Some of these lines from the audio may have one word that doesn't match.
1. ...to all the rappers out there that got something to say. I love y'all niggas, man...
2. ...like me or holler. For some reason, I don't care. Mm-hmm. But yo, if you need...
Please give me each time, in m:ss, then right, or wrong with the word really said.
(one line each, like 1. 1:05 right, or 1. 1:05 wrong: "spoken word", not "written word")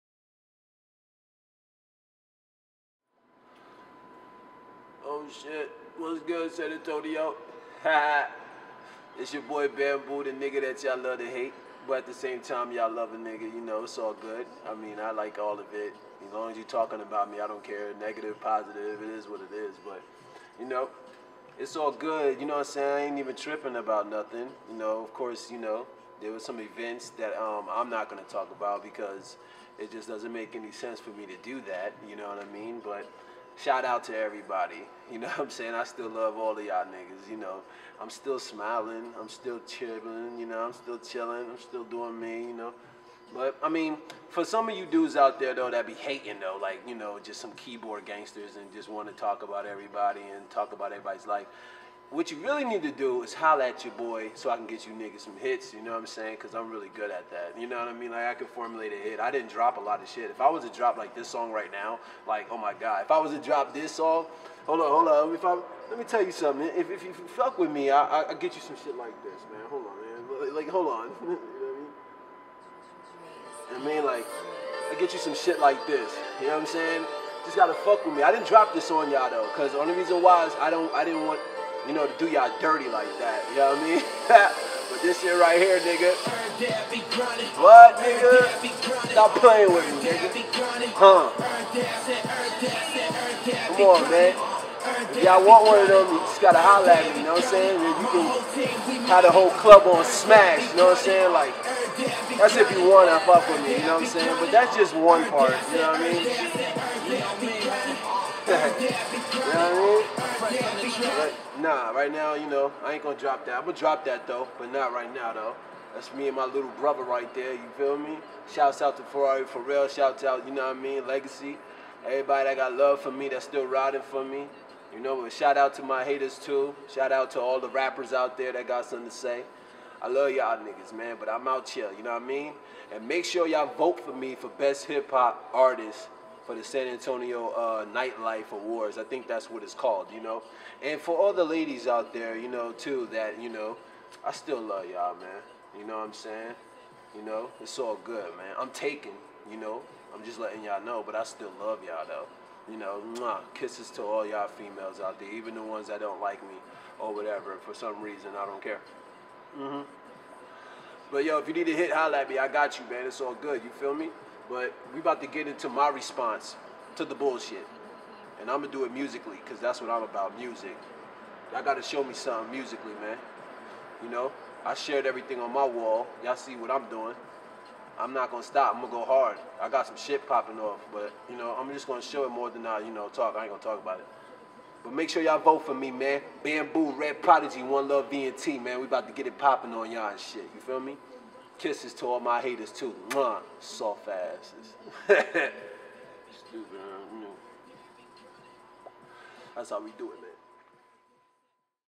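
1. 2:07 right
2. 2:36 wrong: "whatever", not "holler".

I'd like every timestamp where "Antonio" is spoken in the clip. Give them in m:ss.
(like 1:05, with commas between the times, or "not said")
0:06, 2:16.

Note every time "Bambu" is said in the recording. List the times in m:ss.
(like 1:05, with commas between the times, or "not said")
0:09, 3:06.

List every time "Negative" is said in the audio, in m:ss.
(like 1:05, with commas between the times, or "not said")
0:17.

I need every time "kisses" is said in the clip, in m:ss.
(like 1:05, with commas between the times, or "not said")
2:33, 3:11.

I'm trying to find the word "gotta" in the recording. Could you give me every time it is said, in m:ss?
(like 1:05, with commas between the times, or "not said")
1:17, 1:36, 2:51.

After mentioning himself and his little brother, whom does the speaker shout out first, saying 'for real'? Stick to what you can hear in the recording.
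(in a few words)
Ferrari.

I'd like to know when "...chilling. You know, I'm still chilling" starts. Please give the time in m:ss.
0:39.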